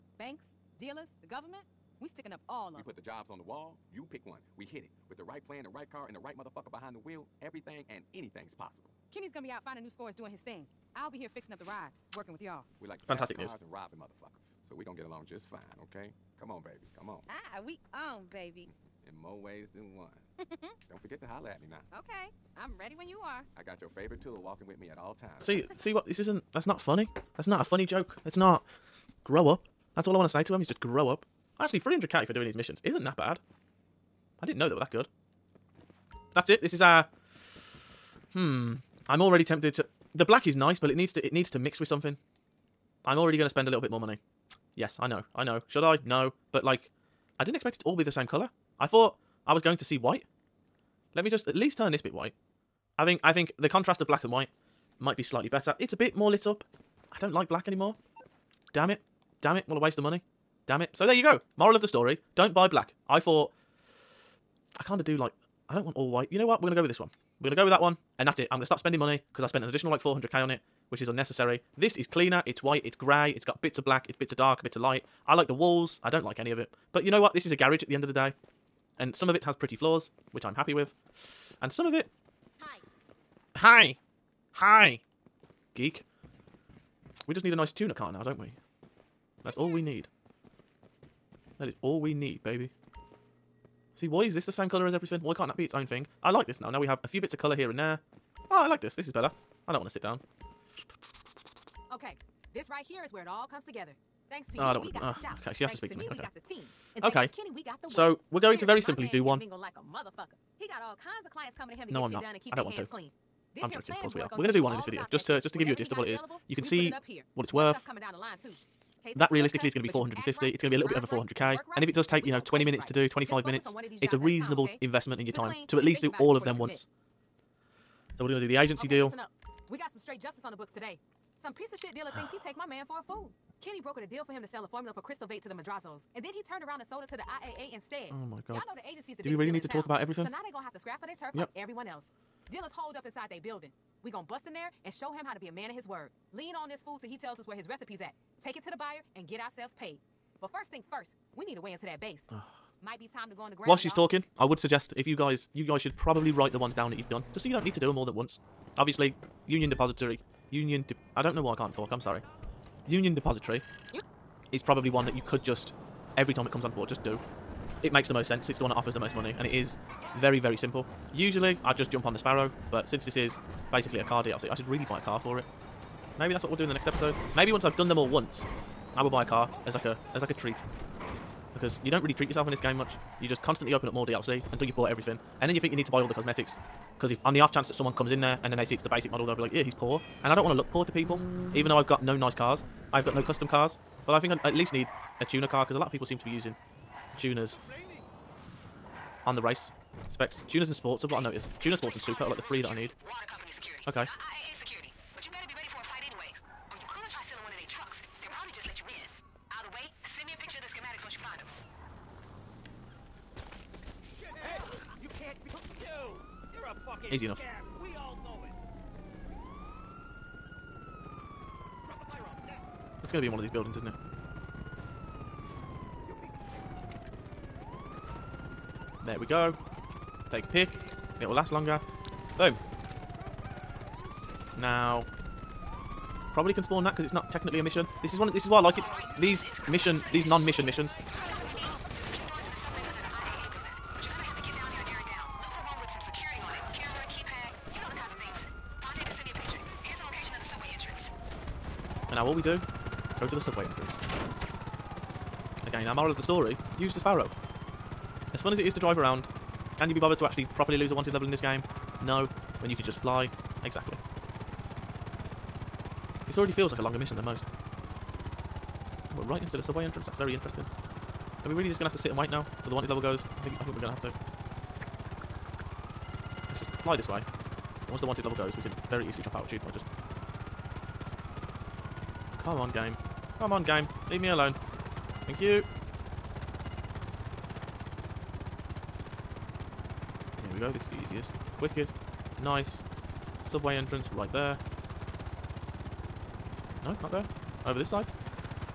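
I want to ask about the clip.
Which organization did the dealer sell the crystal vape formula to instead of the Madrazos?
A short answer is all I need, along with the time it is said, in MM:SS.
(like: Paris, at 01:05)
IAA, at 02:17.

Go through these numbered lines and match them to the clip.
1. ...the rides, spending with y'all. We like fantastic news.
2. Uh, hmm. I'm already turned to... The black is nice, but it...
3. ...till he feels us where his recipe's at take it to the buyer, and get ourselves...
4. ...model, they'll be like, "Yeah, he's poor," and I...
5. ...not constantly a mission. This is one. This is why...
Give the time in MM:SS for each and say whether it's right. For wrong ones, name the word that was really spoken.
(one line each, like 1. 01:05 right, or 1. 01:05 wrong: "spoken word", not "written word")
1. 00:11 wrong: "working", not "spending"
2. 00:37 wrong: "tempted", not "turned"
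3. 02:26 wrong: "tells", not "feels"
4. 03:09 right
5. 03:57 wrong: "technically", not "constantly".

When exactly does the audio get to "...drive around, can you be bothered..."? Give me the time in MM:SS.
04:18.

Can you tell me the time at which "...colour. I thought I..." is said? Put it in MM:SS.
00:48.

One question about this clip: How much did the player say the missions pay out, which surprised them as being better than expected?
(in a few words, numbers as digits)
300k.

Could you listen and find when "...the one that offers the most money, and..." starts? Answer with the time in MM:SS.
02:48.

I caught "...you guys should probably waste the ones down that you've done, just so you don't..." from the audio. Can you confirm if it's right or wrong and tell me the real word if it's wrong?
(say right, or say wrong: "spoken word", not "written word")
wrong: "write", not "waste".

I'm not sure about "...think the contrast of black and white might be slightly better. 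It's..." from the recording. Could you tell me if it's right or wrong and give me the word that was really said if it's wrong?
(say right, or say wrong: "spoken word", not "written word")
right.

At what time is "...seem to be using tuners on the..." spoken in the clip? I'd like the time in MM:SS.
03:16.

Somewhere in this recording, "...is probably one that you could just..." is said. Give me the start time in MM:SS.
02:44.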